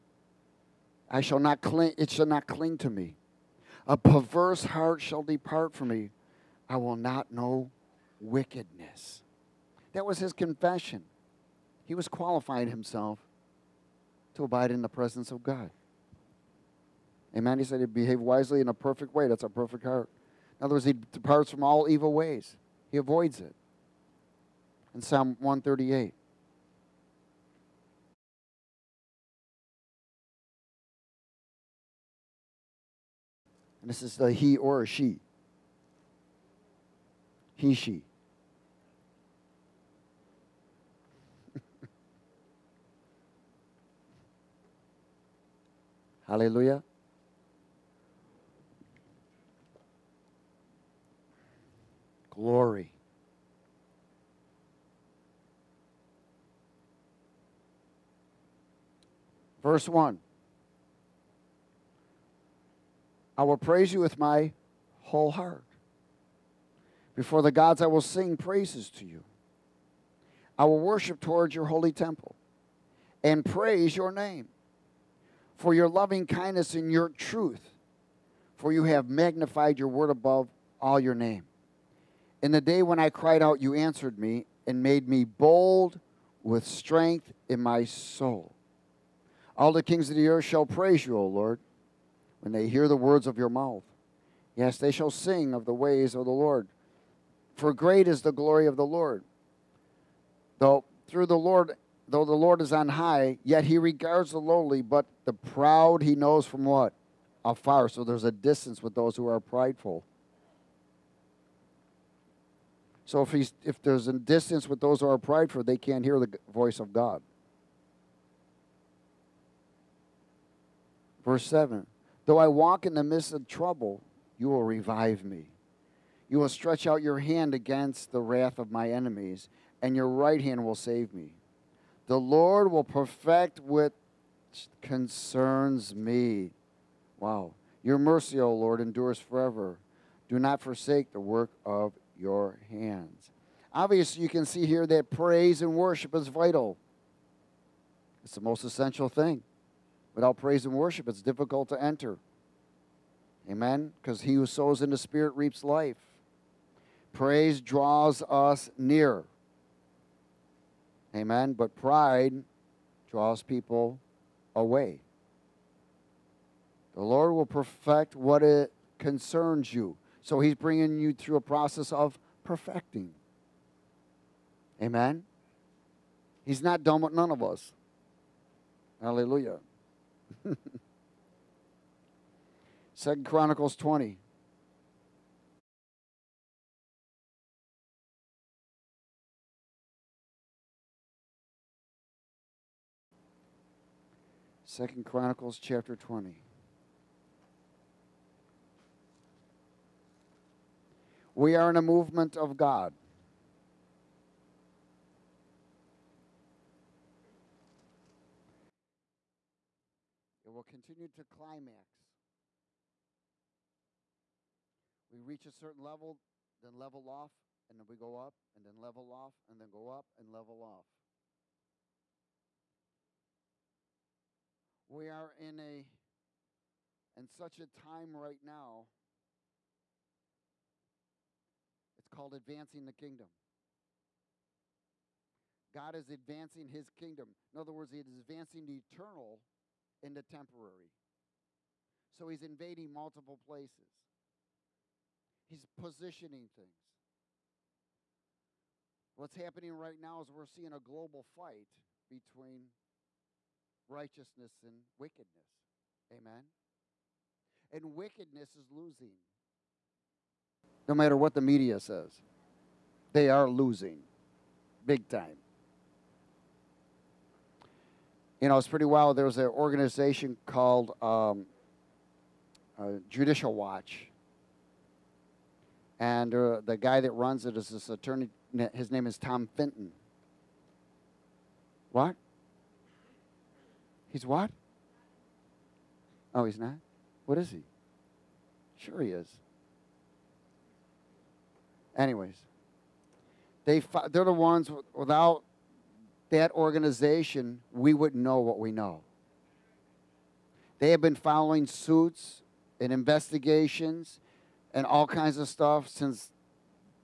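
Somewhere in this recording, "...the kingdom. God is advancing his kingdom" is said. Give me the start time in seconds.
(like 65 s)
232 s.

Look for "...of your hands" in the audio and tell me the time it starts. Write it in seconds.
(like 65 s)
141 s.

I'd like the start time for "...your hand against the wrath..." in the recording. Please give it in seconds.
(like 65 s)
127 s.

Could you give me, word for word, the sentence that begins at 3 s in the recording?
A perverse heart shall depart from me.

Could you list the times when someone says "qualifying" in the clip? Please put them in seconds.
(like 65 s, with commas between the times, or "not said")
12 s.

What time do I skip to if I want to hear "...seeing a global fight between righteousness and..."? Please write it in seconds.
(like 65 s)
250 s.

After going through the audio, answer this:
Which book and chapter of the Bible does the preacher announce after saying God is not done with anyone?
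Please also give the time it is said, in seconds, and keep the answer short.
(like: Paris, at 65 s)
Second Chronicles 20, at 182 s.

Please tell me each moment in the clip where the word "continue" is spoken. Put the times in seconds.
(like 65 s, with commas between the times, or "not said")
210 s.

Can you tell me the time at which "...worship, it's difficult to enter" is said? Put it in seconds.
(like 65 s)
150 s.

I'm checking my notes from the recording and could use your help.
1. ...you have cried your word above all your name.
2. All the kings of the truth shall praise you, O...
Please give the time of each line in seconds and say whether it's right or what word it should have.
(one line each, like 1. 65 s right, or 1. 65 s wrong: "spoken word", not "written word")
1. 78 s wrong: "magnified", not "cried"
2. 89 s wrong: "earth", not "truth".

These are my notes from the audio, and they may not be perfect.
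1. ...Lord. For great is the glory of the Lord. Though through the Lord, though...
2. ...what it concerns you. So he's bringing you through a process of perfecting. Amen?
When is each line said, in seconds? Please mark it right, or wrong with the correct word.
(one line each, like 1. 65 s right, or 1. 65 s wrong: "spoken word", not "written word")
1. 96 s right
2. 168 s right.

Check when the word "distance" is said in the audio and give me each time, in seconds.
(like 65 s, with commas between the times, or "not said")
108 s, 114 s.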